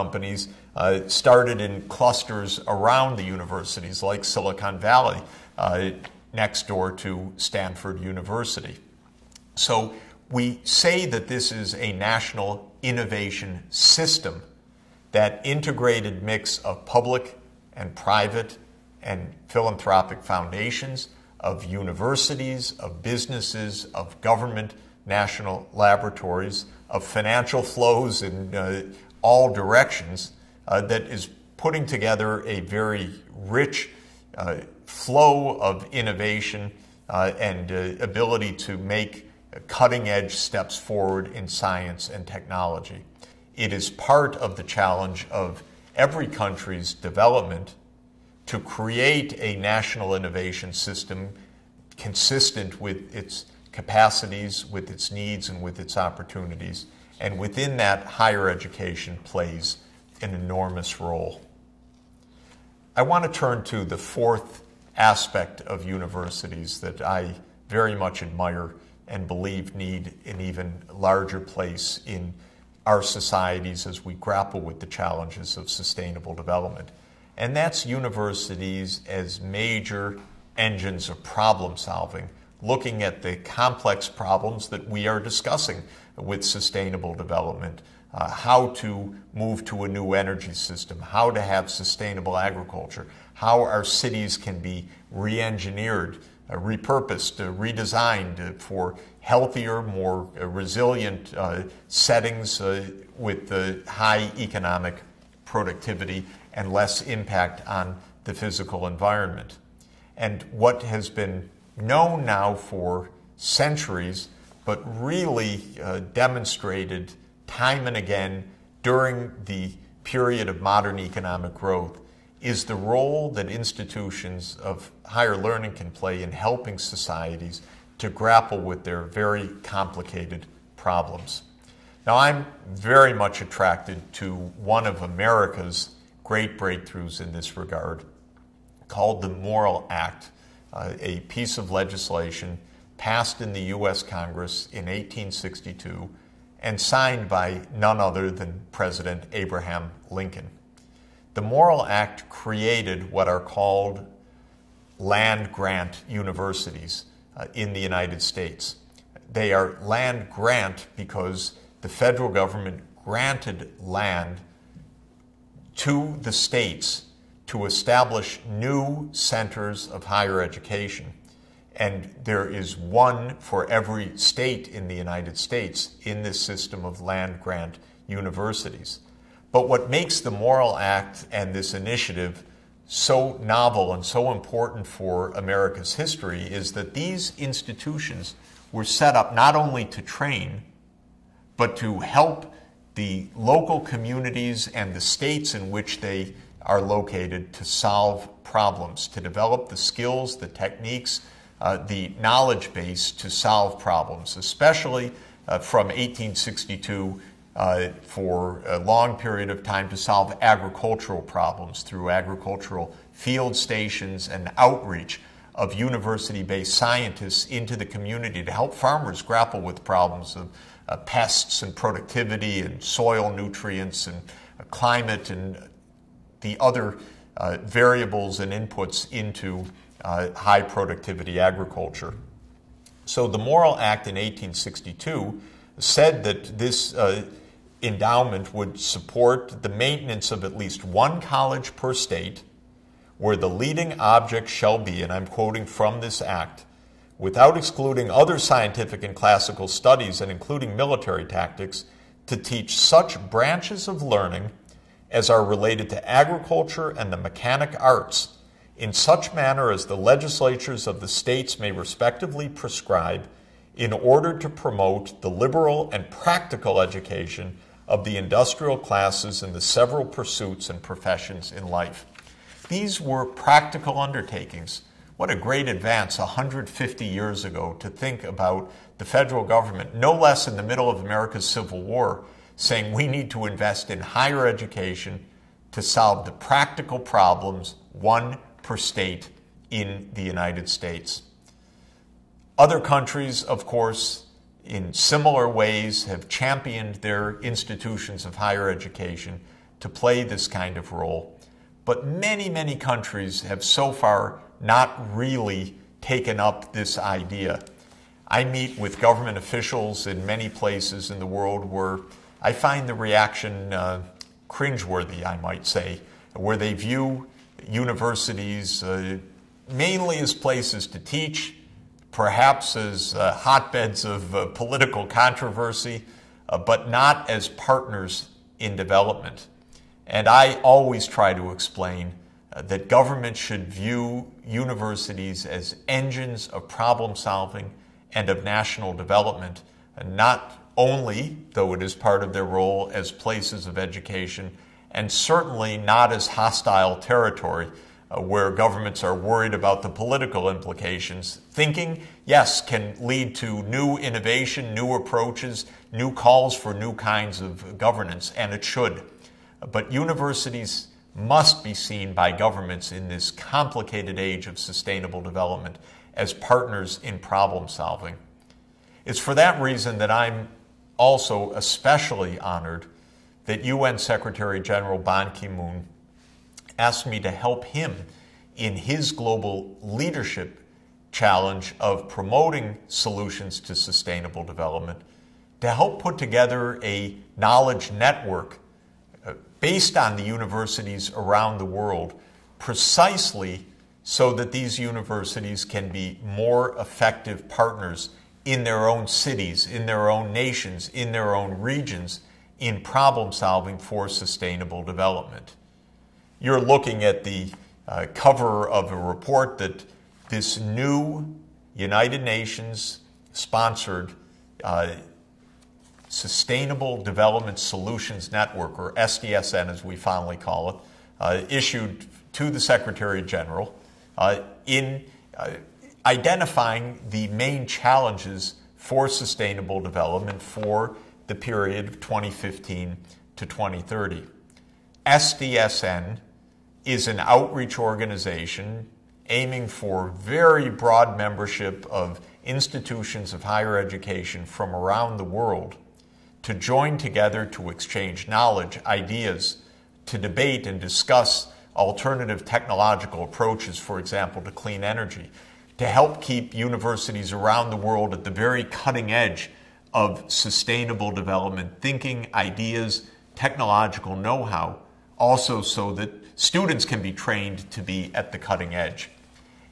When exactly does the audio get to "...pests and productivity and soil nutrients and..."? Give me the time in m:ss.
3:40.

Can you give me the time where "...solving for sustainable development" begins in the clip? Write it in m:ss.
6:43.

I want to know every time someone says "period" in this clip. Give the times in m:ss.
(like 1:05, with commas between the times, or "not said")
2:00, 3:29, 7:11.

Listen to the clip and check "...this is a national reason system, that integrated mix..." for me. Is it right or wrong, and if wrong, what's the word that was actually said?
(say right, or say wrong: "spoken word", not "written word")
wrong: "innovation", not "reason".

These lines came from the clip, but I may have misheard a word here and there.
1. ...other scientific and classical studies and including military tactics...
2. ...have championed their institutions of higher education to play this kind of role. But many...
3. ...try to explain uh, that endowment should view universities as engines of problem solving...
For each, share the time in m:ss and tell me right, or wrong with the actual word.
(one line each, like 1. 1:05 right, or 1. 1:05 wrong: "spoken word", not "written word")
1. 4:08 right
2. 4:56 right
3. 5:31 wrong: "government", not "endowment".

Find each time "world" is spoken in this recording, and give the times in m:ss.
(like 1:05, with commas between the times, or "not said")
5:11, 6:31, 7:25, 7:37.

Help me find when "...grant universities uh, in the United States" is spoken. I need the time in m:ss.
2:35.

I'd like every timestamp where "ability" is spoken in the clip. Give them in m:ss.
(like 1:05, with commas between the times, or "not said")
0:38.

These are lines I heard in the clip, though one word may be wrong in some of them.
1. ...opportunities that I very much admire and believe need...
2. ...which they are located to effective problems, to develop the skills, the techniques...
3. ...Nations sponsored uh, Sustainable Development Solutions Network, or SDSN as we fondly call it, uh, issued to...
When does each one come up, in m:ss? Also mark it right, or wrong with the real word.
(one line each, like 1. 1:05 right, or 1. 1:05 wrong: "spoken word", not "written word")
1. 1:05 wrong: "universities", not "opportunities"
2. 3:15 wrong: "solve", not "effective"
3. 6:52 right.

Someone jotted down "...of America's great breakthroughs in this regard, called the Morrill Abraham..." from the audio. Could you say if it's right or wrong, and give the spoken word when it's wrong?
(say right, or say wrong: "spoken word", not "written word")
wrong: "Act", not "Abraham".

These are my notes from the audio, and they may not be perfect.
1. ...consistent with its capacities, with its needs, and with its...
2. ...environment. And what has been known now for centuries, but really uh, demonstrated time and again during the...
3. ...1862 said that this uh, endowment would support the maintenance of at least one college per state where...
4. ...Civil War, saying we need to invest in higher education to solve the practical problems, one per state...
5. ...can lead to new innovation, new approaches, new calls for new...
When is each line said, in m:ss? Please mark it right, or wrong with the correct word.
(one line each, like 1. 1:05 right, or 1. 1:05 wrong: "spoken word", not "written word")
1. 0:51 right
2. 1:48 right
3. 3:54 right
4. 4:41 right
5. 5:52 right.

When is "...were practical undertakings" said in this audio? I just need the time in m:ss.
4:33.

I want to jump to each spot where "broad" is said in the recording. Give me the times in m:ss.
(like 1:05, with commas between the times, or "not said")
7:20.